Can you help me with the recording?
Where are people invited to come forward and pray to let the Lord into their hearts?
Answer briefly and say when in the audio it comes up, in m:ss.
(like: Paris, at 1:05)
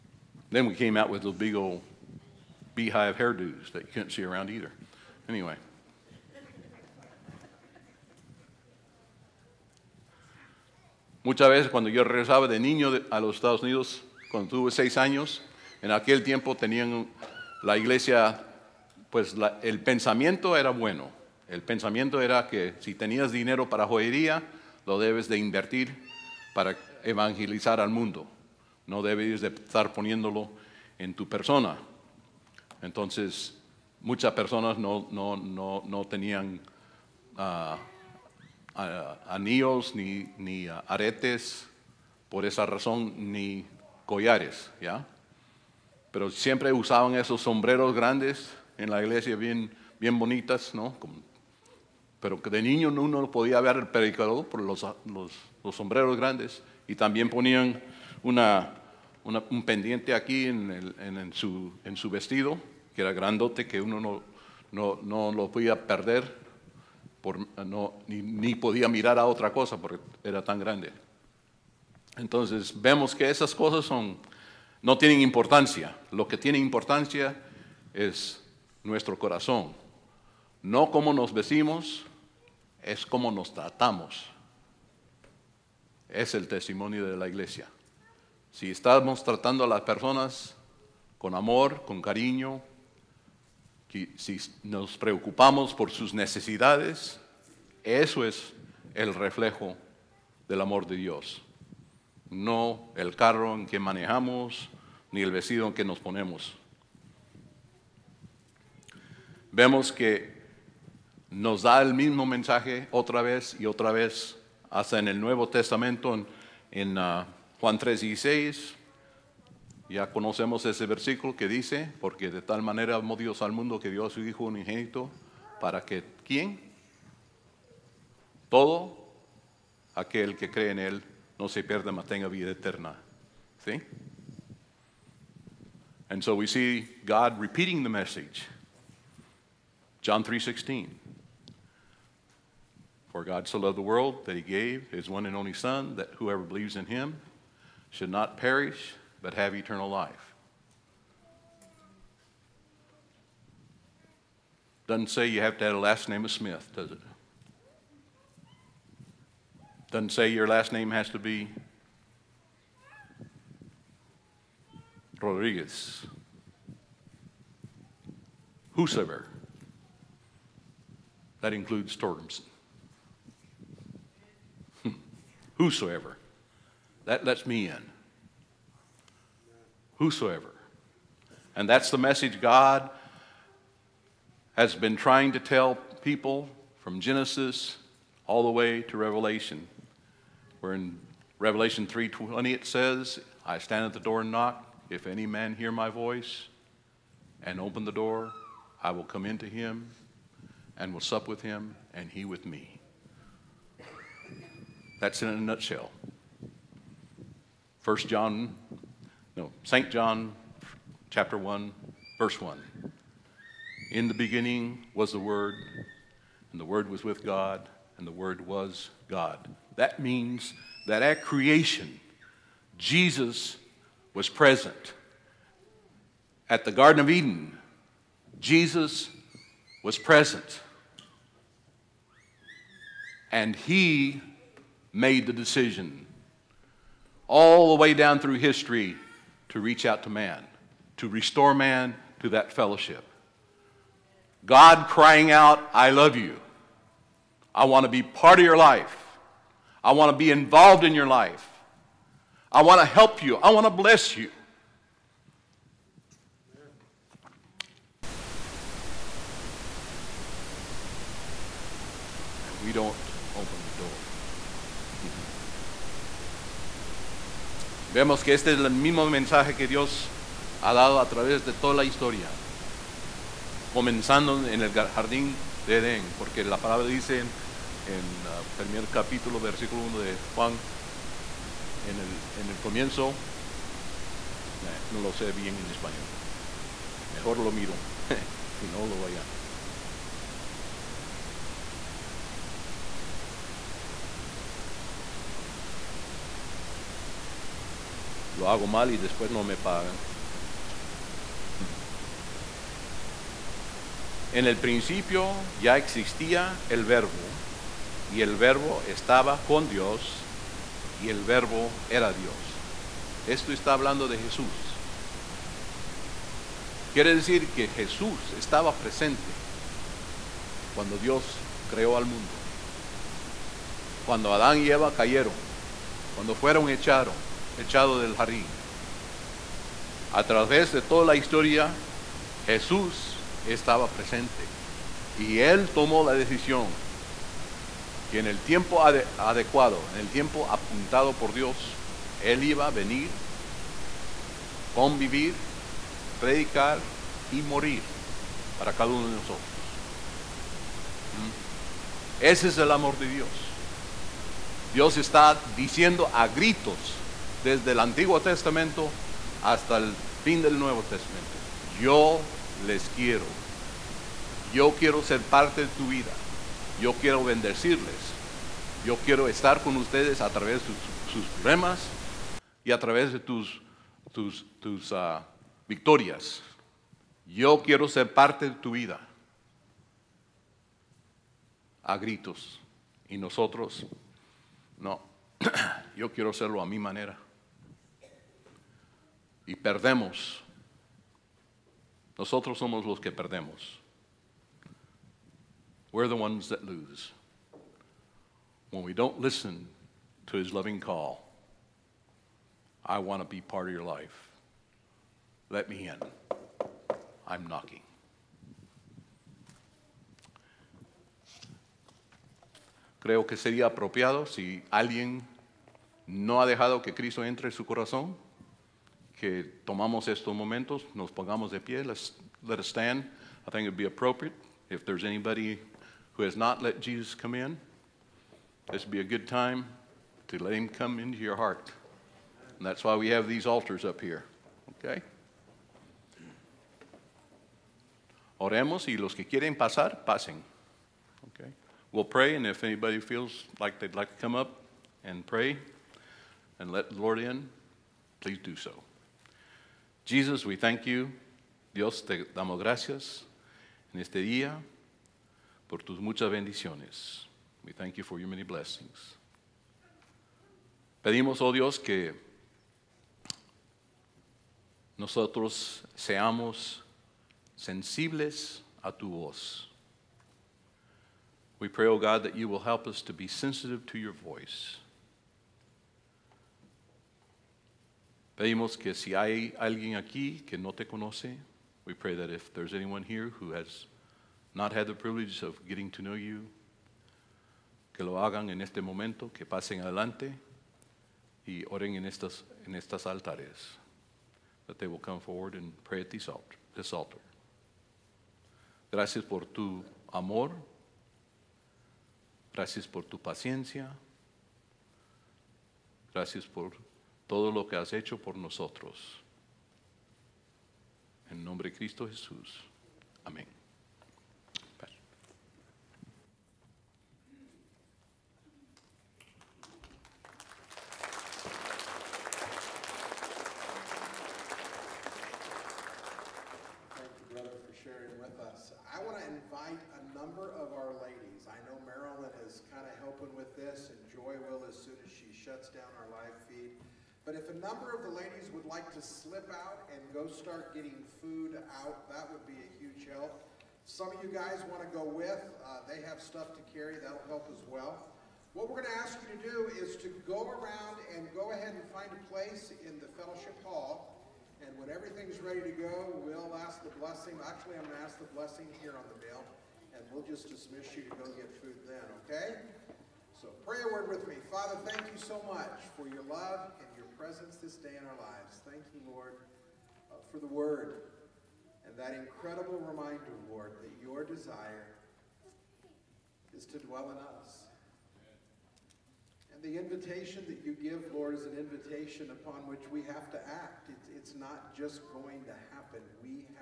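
altars, at 7:13.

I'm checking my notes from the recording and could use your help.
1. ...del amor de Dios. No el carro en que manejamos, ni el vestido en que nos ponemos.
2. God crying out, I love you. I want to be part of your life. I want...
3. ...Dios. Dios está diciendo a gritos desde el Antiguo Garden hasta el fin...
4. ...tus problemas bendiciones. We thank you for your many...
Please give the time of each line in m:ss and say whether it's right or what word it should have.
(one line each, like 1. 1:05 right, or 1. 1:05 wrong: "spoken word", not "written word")
1. 1:40 right
2. 4:04 right
3. 5:53 wrong: "Testamento", not "Garden"
4. 7:35 wrong: "muchas", not "problemas".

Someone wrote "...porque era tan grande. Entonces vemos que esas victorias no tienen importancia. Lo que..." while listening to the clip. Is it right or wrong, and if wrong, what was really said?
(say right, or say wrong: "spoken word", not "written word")
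wrong: "cosas", not "victorias".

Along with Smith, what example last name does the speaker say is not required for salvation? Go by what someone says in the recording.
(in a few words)
Rodriguez.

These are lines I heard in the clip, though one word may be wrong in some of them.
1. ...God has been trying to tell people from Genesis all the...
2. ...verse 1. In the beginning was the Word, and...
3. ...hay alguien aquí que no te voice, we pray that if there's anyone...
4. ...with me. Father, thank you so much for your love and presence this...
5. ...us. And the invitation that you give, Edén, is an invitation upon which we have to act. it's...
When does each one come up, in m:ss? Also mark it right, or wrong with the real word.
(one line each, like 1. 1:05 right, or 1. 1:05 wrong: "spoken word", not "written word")
1. 3:02 right
2. 3:32 right
3. 7:59 wrong: "conoce", not "voice"
4. 9:24 right
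5. 9:37 wrong: "Lord", not "Edén".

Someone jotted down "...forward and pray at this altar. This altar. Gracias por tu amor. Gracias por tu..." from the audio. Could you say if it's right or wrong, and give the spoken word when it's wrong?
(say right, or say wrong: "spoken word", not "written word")
right.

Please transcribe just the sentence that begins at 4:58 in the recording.
lo hago mal y después no me pagan.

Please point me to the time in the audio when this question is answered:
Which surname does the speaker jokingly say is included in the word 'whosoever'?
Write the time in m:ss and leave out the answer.
2:51.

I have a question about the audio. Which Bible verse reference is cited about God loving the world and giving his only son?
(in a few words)
Juan 3:16.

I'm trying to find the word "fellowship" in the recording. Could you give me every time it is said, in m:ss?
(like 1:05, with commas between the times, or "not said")
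4:02, 9:13.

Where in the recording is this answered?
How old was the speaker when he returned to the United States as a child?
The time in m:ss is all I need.
0:14.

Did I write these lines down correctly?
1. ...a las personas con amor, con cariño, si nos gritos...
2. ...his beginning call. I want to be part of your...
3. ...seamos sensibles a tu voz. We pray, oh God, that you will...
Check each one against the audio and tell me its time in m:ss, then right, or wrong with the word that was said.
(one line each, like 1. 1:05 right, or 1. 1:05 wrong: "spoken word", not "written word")
1. 1:29 wrong: "preocupamos", not "gritos"
2. 6:40 wrong: "loving", not "beginning"
3. 7:45 right.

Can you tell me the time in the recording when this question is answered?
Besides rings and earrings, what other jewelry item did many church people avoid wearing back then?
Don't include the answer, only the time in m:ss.
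0:44.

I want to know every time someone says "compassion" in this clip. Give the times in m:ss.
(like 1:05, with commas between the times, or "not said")
not said.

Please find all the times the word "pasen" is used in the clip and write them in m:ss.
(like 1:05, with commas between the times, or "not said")
7:20, 8:09.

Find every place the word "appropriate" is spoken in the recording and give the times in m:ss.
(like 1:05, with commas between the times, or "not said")
7:03.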